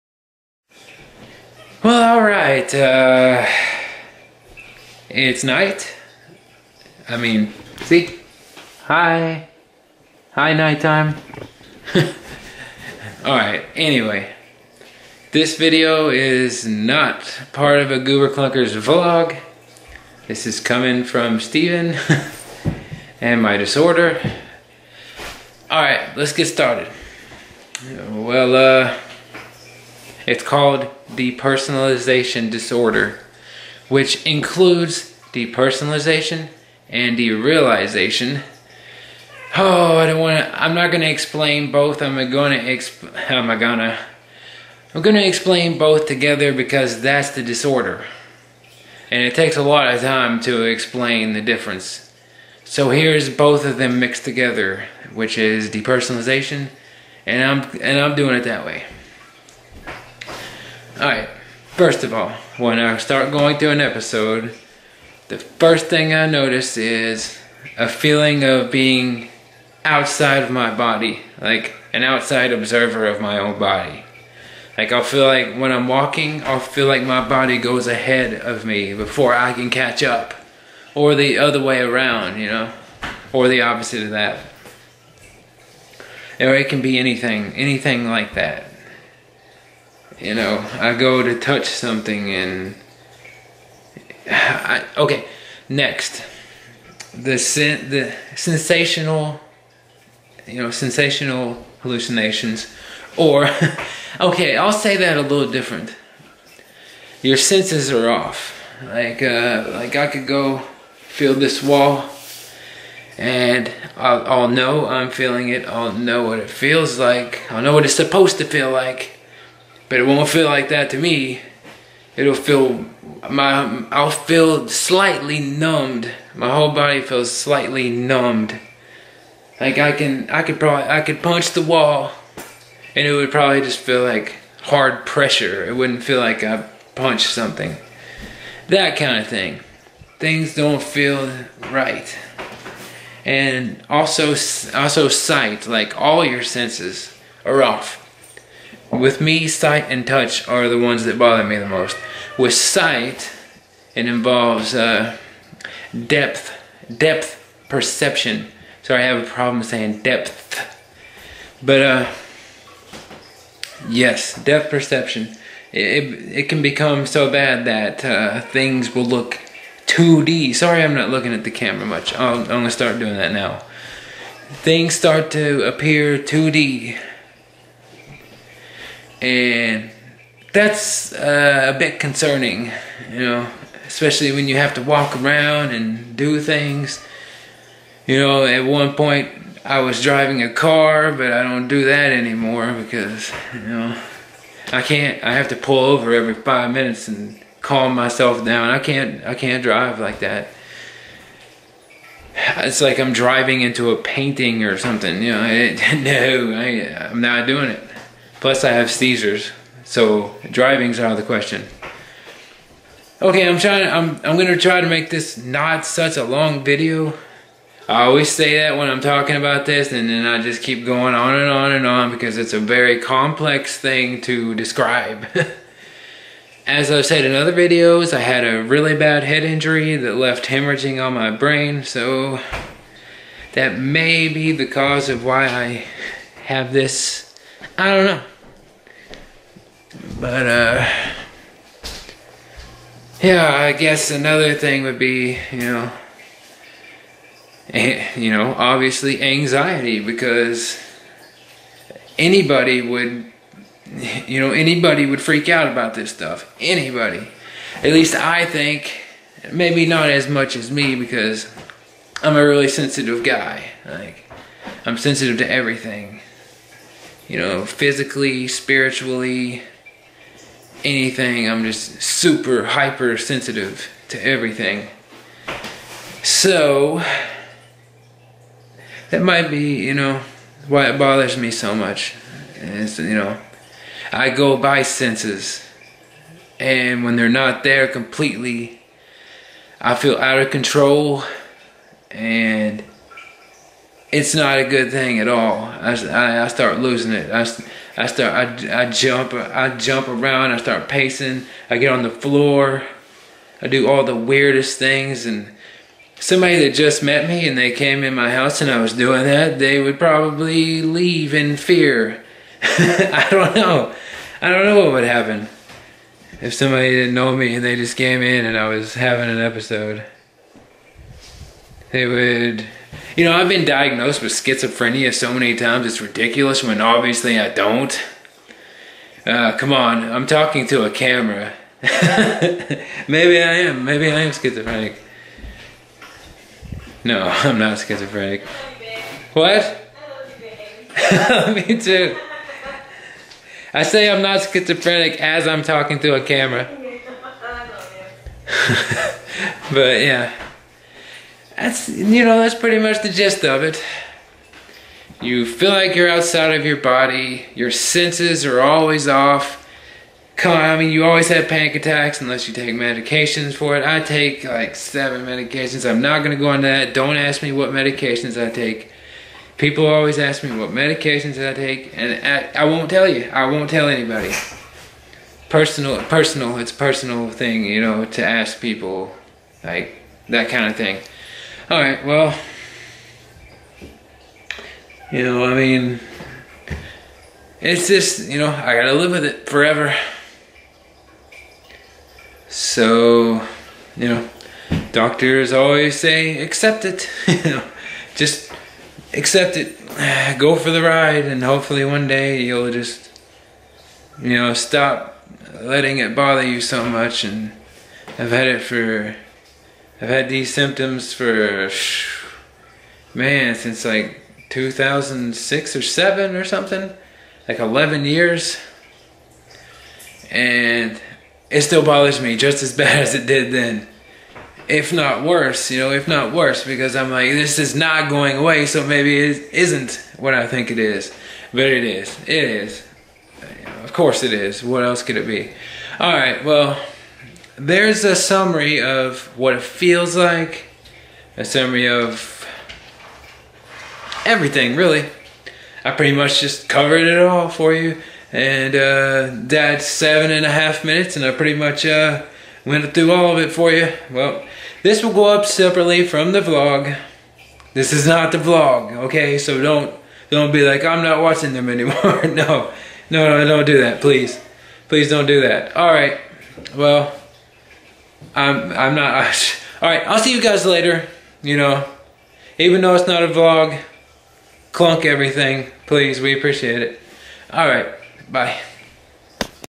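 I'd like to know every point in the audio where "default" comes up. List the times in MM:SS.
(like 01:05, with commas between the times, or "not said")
not said.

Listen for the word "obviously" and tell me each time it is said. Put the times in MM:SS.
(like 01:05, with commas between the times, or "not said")
04:08, 05:26.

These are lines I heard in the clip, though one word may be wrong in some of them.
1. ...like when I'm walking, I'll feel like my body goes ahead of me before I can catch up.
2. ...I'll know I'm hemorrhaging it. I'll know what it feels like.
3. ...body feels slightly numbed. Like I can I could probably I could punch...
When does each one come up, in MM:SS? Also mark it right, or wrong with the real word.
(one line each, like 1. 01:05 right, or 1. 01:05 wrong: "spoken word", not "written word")
1. 01:15 right
2. 01:54 wrong: "feeling", not "hemorrhaging"
3. 02:06 right.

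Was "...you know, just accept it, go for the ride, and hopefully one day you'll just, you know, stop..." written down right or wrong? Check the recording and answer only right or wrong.
right.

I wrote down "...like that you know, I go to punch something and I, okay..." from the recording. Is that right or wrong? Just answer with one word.
wrong.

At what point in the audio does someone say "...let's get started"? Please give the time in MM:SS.
00:26.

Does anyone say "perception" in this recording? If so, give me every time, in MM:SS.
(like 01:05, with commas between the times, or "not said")
02:37, 02:44.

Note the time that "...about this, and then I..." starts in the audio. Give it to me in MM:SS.
03:39.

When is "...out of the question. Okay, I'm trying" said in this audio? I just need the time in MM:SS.
03:30.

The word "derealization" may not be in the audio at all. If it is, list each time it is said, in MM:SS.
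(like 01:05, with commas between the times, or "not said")
00:37.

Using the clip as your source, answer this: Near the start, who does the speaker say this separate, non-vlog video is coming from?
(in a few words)
Stephen.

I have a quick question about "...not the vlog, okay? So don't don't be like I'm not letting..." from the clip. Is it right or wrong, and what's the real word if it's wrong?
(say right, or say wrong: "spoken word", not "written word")
wrong: "watching", not "letting".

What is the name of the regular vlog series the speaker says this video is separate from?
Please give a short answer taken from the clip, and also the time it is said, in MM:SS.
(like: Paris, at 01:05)
Goober Clunkers, at 00:17.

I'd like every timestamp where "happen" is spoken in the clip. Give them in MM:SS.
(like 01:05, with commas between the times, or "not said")
05:15.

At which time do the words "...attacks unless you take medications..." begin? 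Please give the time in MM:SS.
06:01.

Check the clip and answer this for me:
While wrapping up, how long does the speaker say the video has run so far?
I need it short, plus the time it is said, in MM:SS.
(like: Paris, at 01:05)
7 and a half minutes, at 07:29.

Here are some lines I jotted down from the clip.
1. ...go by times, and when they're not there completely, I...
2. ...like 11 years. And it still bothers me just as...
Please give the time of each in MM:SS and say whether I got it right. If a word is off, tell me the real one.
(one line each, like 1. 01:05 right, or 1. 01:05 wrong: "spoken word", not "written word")
1. 04:44 wrong: "senses", not "times"
2. 06:57 right.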